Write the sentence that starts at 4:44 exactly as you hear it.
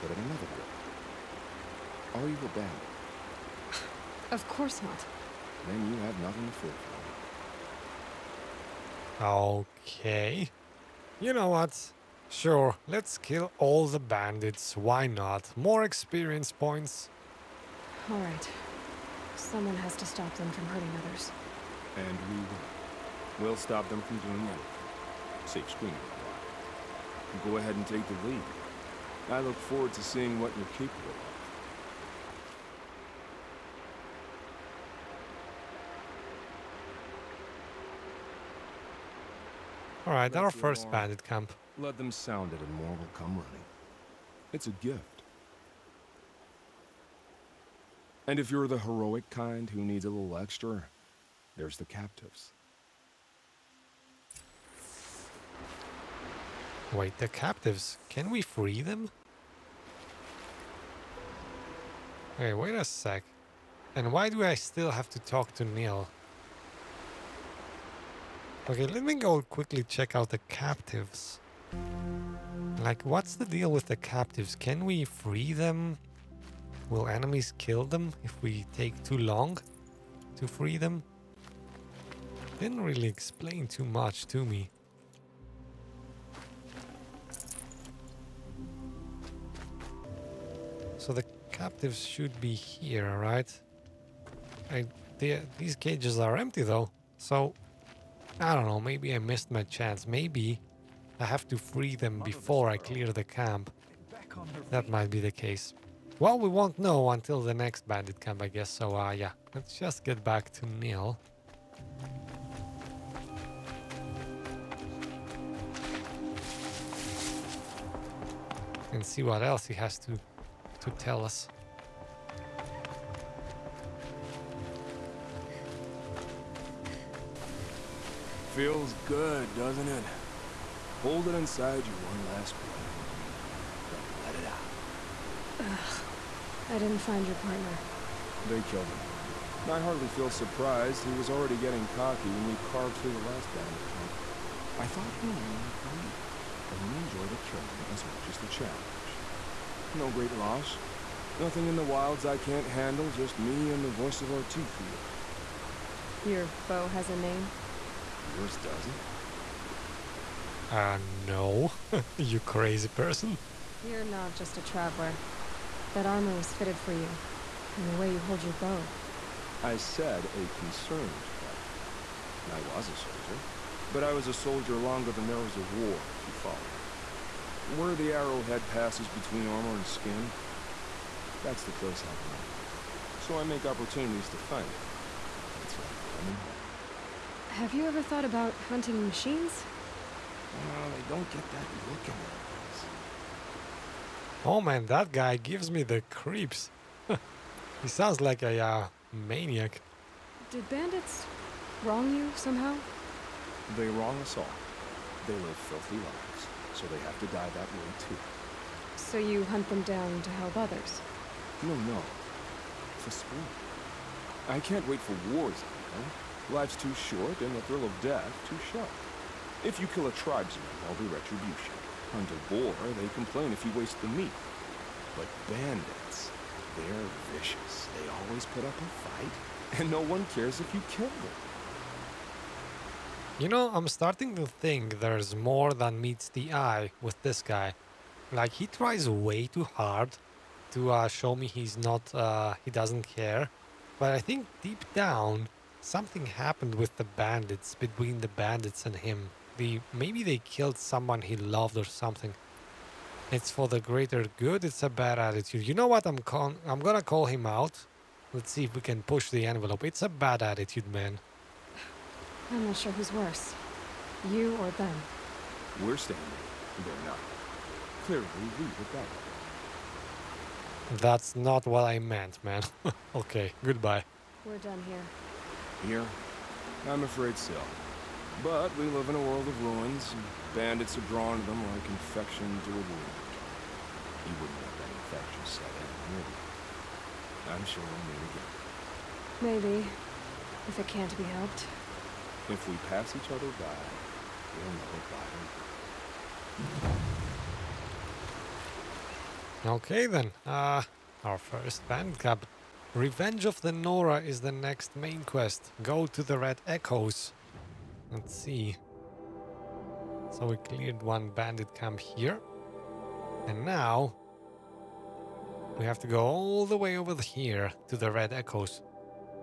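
You wouldn't let that infection set in, would I'm sure we'll meet again.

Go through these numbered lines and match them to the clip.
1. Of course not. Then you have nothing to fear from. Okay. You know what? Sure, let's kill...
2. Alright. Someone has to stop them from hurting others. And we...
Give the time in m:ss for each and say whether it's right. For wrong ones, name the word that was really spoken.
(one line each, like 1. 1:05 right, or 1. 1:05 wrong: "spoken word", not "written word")
1. 0:04 right
2. 0:18 right.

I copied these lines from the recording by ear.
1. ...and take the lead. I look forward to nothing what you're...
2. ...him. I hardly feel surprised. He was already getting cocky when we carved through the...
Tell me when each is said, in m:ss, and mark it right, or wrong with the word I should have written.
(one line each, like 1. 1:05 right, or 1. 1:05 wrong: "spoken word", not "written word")
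1. 0:27 wrong: "seeing", not "nothing"
2. 2:18 right.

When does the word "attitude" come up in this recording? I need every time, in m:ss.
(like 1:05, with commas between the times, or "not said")
4:15, 4:20.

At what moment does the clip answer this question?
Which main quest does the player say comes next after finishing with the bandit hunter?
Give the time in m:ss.
5:02.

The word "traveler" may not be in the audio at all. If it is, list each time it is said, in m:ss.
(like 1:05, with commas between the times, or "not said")
2:44, 2:52.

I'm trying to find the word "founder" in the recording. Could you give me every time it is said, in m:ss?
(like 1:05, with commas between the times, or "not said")
not said.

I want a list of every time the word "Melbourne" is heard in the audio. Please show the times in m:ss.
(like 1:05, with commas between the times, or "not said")
not said.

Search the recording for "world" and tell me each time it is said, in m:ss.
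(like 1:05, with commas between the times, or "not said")
4:39.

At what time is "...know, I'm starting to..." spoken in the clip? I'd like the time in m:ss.
3:53.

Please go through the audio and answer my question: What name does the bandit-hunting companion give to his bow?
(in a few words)
Voice of Ortiz.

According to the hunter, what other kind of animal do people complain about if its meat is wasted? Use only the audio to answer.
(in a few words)
Boar.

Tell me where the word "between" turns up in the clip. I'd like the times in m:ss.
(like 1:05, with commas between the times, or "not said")
2:59, 4:07.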